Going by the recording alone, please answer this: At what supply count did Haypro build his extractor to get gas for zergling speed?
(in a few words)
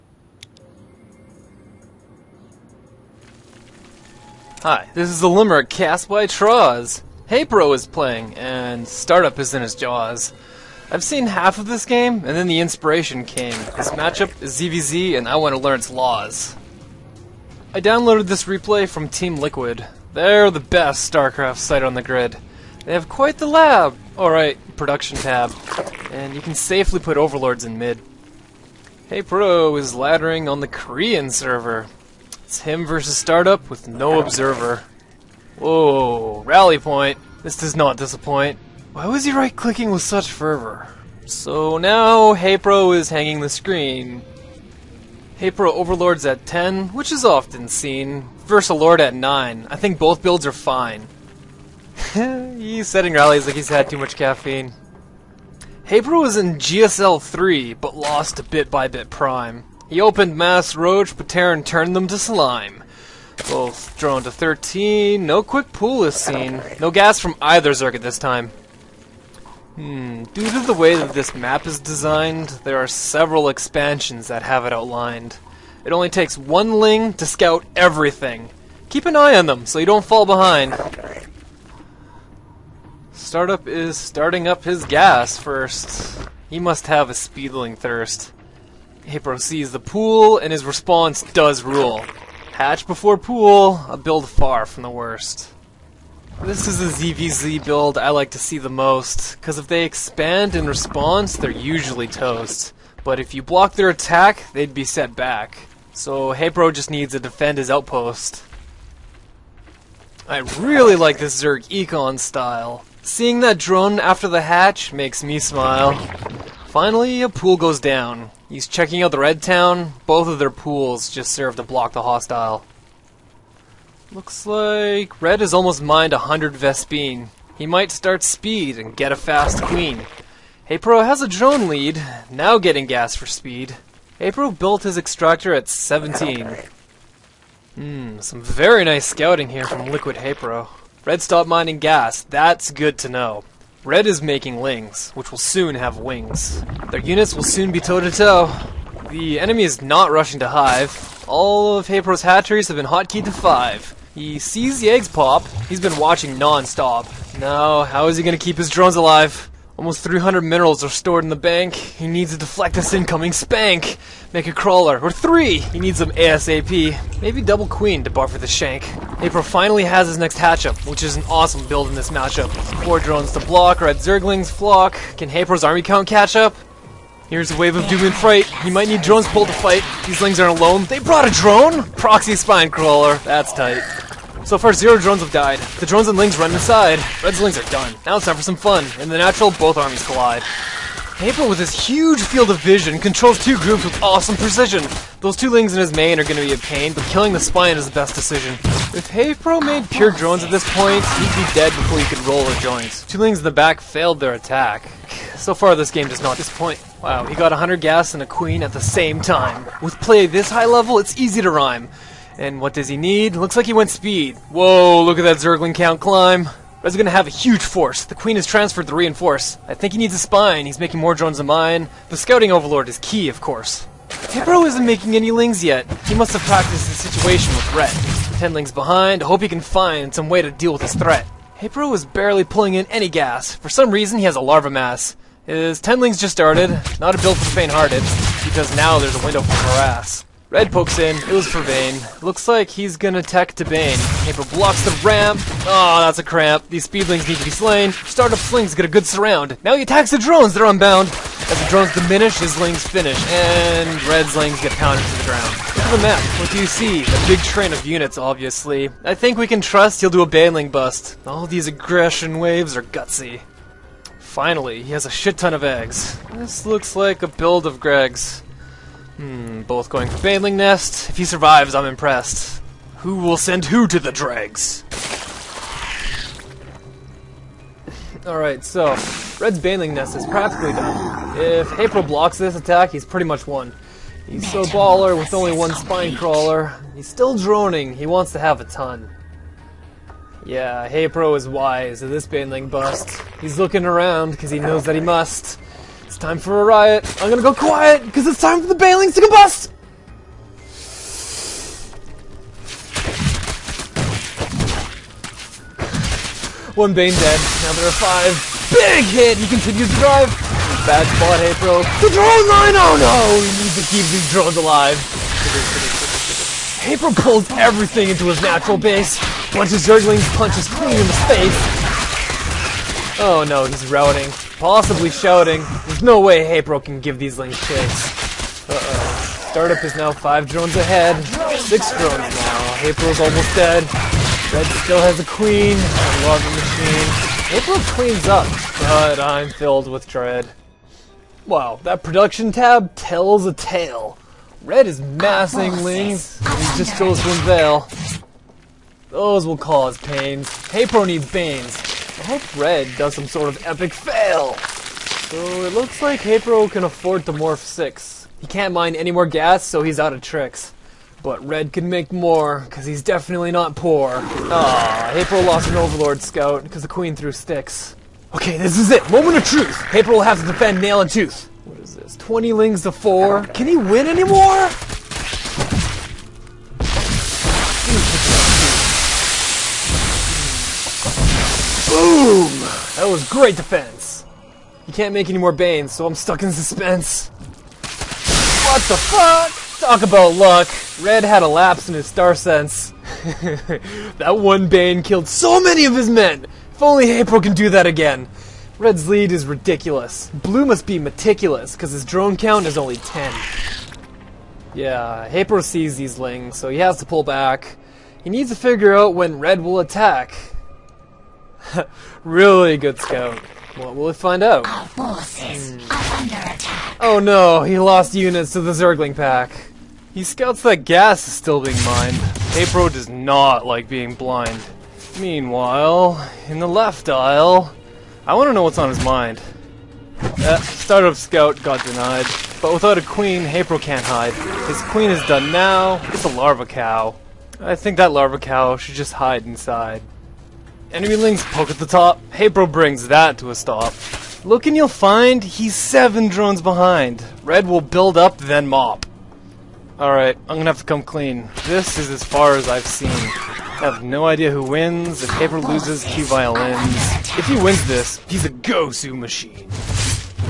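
17.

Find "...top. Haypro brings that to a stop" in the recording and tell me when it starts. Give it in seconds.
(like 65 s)
441 s.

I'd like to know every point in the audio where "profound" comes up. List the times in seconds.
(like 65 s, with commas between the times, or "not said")
not said.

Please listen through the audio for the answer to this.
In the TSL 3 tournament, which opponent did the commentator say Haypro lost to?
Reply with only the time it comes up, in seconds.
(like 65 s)
58 s.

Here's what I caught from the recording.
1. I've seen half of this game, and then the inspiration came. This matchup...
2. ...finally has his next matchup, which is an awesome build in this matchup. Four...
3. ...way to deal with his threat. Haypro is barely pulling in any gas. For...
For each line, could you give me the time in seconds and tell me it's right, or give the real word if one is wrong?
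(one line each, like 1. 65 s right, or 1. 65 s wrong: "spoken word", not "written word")
1. 10 s right
2. 169 s wrong: "hatchup", not "matchup"
3. 230 s right.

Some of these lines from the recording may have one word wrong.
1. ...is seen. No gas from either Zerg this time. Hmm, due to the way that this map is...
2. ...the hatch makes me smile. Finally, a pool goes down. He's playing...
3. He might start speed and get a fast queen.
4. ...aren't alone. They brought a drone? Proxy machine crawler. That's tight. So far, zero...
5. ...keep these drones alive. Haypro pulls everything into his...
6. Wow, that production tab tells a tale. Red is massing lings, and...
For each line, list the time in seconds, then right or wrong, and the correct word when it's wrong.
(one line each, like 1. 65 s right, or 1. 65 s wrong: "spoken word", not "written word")
1. 66 s right
2. 114 s wrong: "checking", not "playing"
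3. 127 s right
4. 180 s wrong: "spine", not "machine"
5. 313 s right
6. 341 s right.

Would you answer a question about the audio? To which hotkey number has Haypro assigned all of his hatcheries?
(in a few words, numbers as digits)
5.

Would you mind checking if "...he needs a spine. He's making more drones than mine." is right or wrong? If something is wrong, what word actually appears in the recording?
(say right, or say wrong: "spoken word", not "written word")
right.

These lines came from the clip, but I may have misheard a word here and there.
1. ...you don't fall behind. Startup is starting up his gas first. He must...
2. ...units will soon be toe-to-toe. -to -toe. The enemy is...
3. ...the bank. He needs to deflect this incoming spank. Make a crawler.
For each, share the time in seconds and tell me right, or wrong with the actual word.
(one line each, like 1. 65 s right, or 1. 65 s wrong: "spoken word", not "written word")
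1. 79 s right
2. 146 s right
3. 161 s right.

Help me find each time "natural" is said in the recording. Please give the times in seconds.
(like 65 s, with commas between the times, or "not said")
189 s, 318 s.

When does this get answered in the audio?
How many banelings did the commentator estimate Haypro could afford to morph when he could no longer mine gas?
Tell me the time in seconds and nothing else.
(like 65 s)
357 s.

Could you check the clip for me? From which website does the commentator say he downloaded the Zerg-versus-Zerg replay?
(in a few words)
Team Liquid.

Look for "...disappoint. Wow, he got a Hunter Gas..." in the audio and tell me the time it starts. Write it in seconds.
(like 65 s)
206 s.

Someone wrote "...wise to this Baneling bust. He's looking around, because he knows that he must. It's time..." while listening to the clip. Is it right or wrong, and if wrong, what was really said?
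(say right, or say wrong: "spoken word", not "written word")
right.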